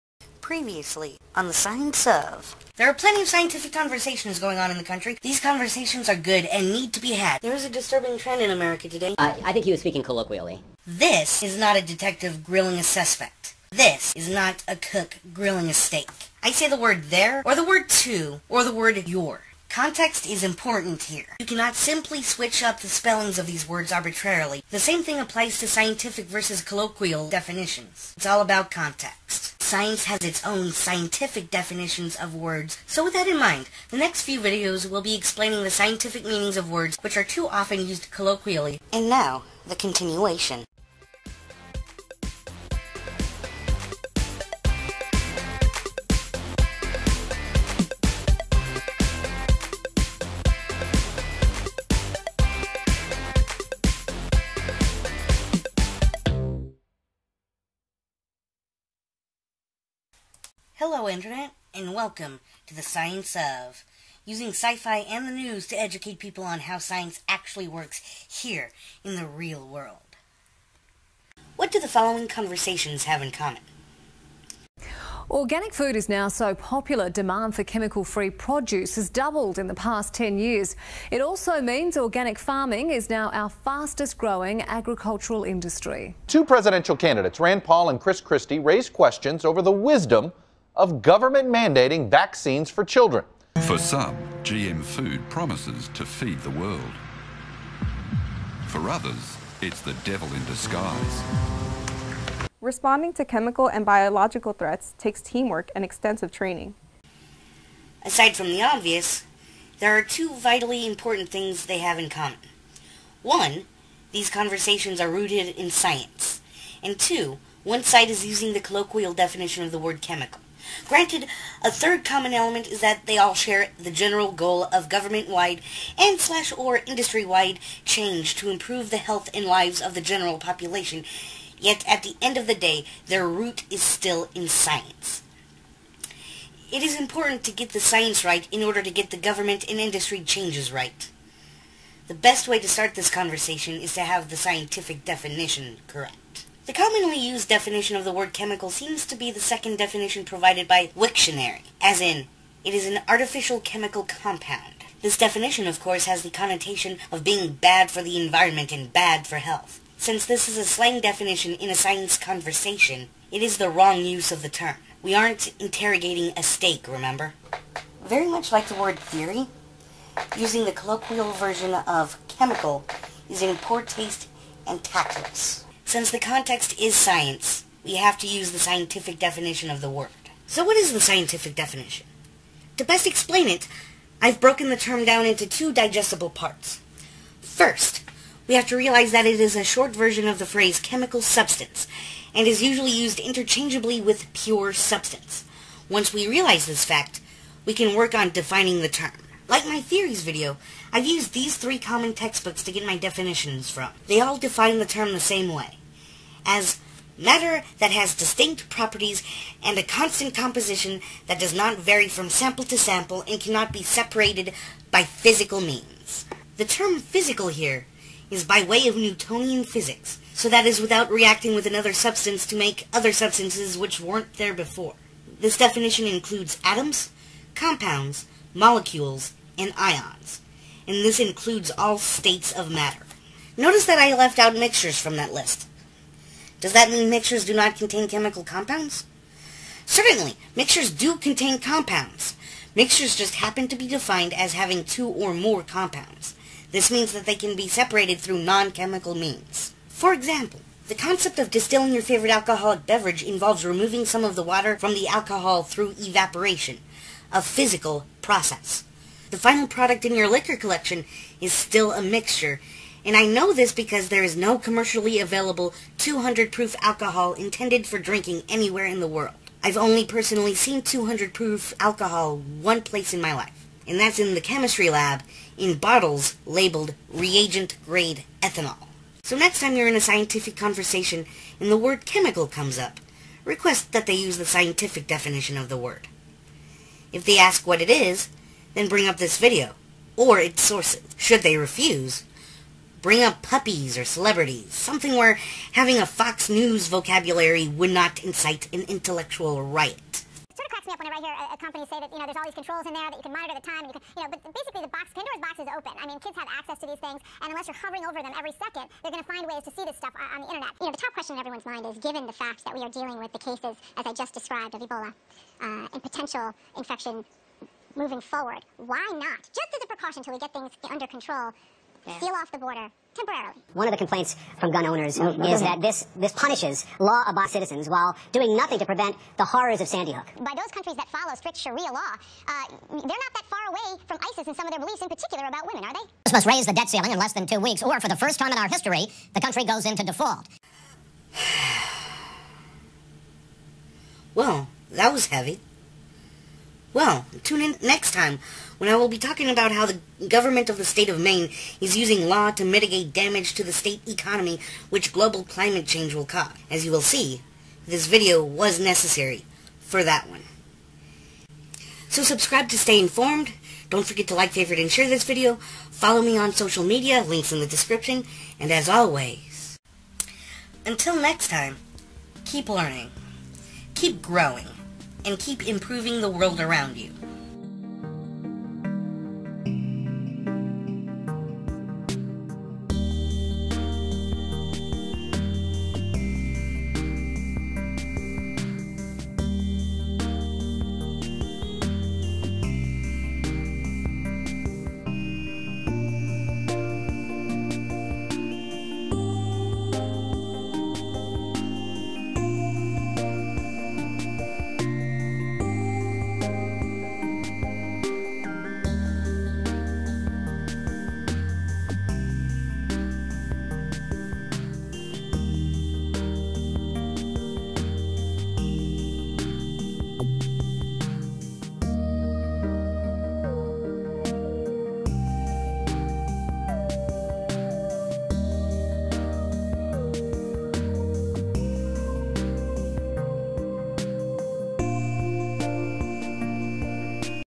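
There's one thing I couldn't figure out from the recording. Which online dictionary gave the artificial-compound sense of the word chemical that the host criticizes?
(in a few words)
Wiktionary.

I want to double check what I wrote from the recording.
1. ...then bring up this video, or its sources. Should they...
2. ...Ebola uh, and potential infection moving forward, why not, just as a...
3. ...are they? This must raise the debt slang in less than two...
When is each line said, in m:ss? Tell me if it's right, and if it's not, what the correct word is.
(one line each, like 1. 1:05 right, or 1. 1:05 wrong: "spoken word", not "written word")
1. 4:48 right
2. 5:14 right
3. 5:35 wrong: "ceiling", not "slang".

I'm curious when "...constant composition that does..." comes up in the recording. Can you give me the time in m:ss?
3:29.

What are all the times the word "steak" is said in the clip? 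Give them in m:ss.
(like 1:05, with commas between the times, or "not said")
0:15, 2:46.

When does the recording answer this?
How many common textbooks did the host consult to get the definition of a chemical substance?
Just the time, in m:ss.
3:21.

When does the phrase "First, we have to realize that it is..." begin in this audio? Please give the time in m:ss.
3:07.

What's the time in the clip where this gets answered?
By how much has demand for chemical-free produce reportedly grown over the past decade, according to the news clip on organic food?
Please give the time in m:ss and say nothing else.
1:19.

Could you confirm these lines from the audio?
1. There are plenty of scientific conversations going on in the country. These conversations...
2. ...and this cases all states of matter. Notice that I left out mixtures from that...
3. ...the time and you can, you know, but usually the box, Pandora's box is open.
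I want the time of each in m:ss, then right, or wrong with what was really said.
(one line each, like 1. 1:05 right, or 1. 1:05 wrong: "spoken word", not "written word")
1. 0:02 right
2. 3:50 wrong: "includes", not "cases"
3. 5:03 wrong: "basically", not "usually".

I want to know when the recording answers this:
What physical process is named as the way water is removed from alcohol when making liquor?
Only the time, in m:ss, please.
4:15.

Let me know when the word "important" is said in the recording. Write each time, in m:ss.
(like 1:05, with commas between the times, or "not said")
0:20, 1:50, 2:16.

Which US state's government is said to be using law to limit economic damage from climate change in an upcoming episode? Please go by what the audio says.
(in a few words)
Maine.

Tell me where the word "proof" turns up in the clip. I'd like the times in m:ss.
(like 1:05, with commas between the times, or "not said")
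4:26, 4:31.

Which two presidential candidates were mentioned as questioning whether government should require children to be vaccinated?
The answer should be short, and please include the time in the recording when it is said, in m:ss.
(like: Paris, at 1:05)
Rand Paul and Chris Christie, at 1:27.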